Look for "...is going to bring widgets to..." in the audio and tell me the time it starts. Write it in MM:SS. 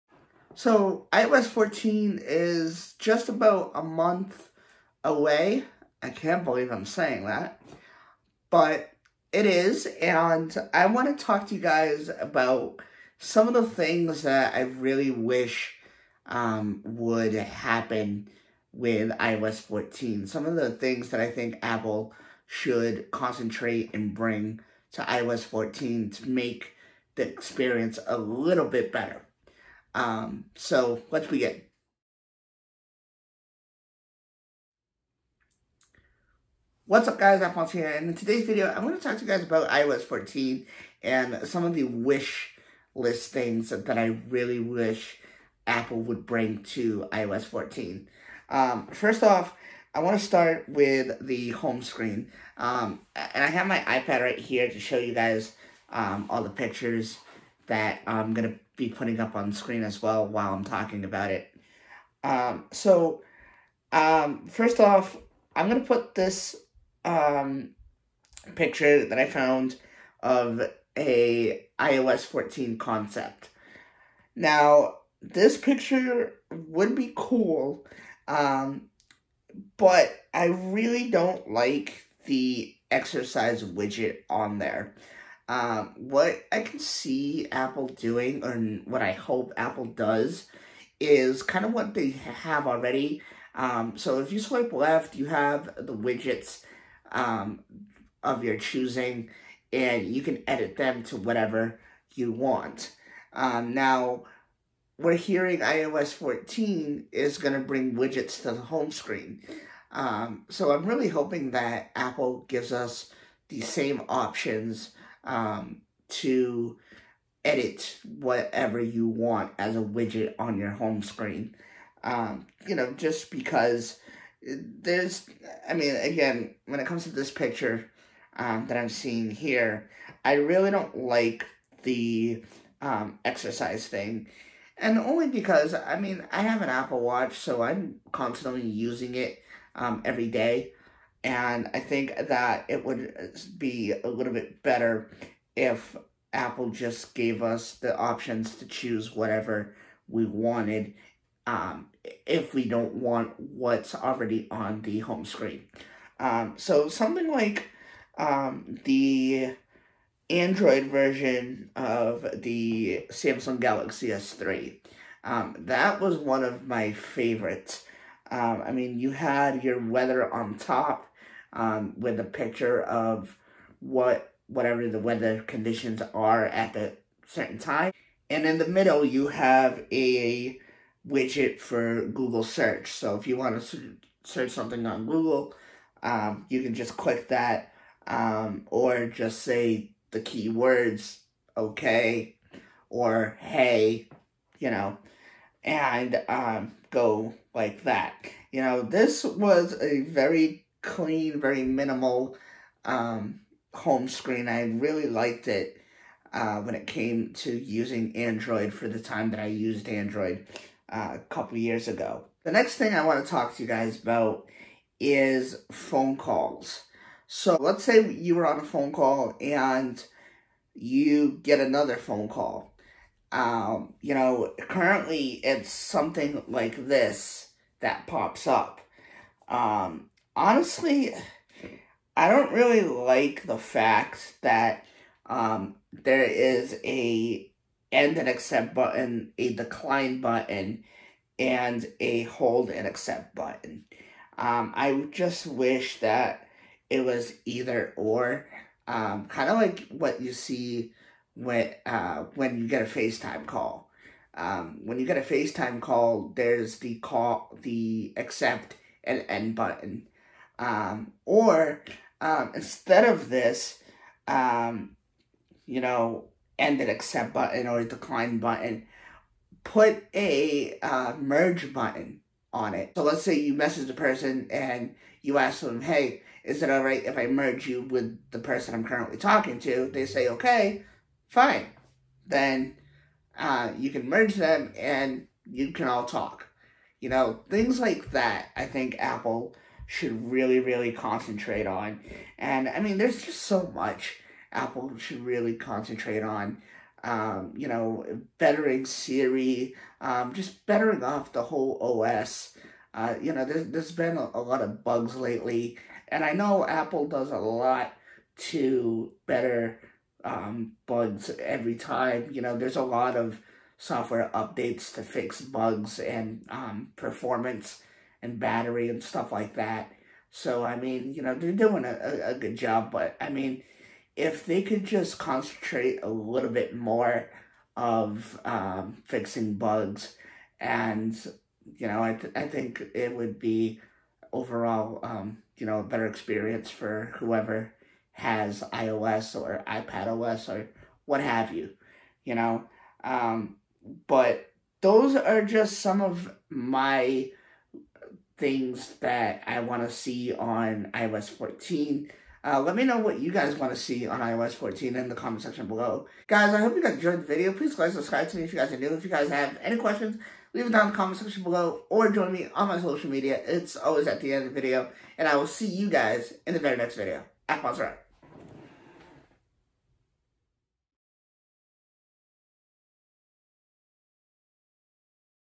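01:47.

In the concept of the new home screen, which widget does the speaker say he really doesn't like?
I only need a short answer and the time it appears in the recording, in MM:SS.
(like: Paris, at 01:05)
Exercise widget, at 01:22.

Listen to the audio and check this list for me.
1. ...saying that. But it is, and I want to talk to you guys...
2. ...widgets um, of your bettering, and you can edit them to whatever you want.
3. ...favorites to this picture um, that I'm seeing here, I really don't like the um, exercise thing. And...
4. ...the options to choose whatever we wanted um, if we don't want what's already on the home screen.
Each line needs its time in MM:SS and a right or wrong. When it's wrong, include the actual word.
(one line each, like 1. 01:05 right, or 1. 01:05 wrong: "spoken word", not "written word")
1. 00:06 right
2. 01:35 wrong: "choosing", not "bettering"
3. 02:06 wrong: "comes", not "favorites"
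4. 02:27 right.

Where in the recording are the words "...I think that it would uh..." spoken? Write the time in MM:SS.
02:21.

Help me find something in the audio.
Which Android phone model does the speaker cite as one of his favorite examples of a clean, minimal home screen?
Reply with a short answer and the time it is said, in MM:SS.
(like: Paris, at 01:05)
Samsung Galaxy S3, at 02:43.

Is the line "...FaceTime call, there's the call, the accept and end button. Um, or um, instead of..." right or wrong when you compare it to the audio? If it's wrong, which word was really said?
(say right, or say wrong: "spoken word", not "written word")
right.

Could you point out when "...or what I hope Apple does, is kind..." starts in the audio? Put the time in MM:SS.
01:28.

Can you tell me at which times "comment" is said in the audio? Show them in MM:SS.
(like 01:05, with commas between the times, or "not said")
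05:55, 06:00.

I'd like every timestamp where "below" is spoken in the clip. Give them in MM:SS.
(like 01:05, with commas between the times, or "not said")
05:55, 06:01.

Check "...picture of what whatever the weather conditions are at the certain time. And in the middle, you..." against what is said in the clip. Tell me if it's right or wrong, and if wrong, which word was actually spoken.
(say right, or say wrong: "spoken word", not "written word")
right.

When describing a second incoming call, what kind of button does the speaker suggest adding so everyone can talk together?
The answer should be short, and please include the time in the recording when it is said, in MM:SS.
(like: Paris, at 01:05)
Merge button, at 04:31.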